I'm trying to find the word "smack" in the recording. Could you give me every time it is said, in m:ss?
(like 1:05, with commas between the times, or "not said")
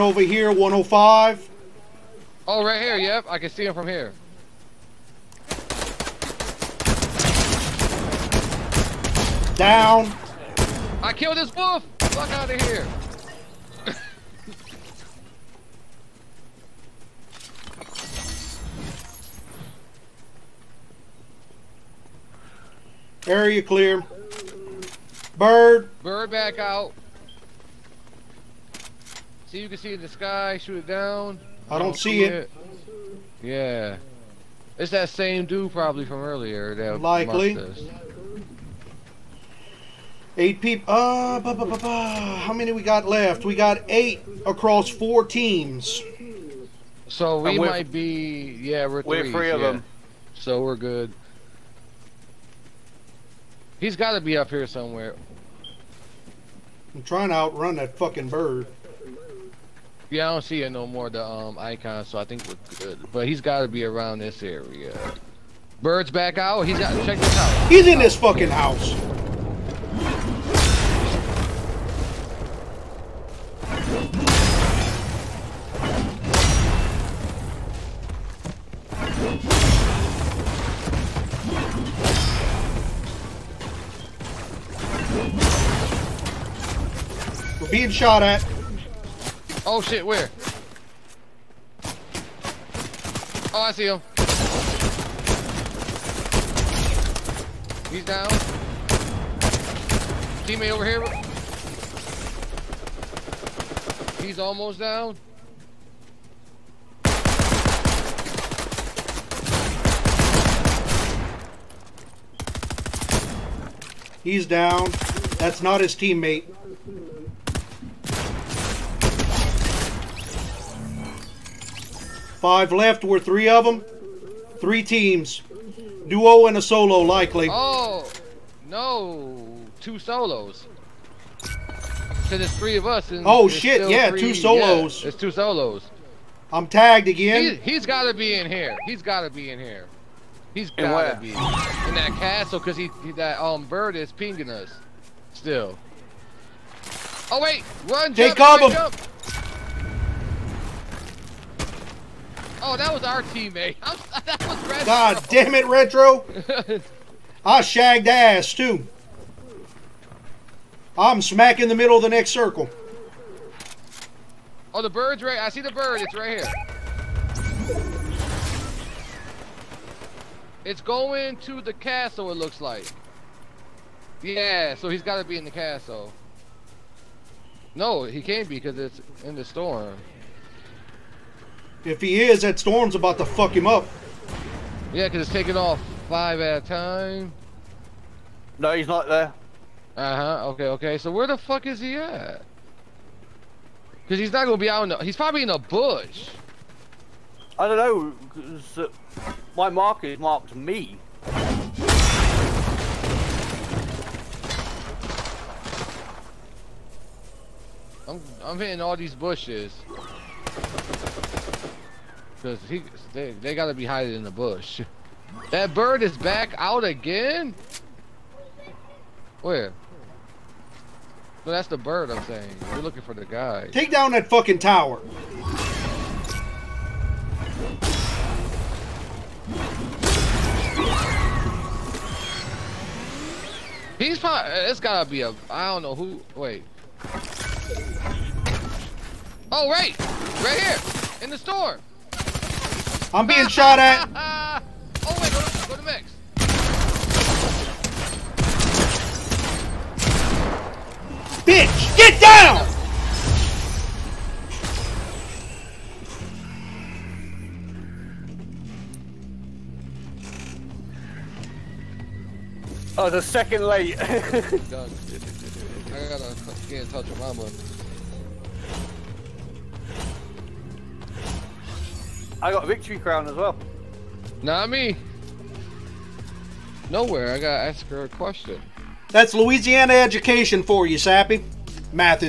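2:41.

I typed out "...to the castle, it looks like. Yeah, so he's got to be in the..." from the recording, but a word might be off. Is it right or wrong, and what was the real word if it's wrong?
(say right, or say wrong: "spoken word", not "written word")
right.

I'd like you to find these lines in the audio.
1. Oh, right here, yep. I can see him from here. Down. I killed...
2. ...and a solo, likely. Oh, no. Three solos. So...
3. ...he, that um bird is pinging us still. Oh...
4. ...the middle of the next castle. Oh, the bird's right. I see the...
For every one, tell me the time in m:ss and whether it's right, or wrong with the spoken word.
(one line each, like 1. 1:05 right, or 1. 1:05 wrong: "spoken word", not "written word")
1. 0:02 right
2. 2:06 wrong: "Two", not "Three"
3. 2:23 right
4. 2:41 wrong: "circle", not "castle".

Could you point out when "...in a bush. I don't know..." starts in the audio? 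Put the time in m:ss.
3:15.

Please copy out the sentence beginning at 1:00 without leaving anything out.
Yeah, I don't see it no more, the um, icon, so I think we're good.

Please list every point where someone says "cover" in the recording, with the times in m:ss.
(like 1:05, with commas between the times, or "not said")
2:28.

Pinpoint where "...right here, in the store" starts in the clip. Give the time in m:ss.
4:00.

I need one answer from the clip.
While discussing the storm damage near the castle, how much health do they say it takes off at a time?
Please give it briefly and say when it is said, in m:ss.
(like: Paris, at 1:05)
5, at 3:06.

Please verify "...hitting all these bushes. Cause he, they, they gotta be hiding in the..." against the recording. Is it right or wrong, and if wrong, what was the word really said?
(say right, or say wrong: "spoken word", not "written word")
right.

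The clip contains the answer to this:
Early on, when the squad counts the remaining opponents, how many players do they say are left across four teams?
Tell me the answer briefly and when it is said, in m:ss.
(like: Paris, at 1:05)
8, at 0:40.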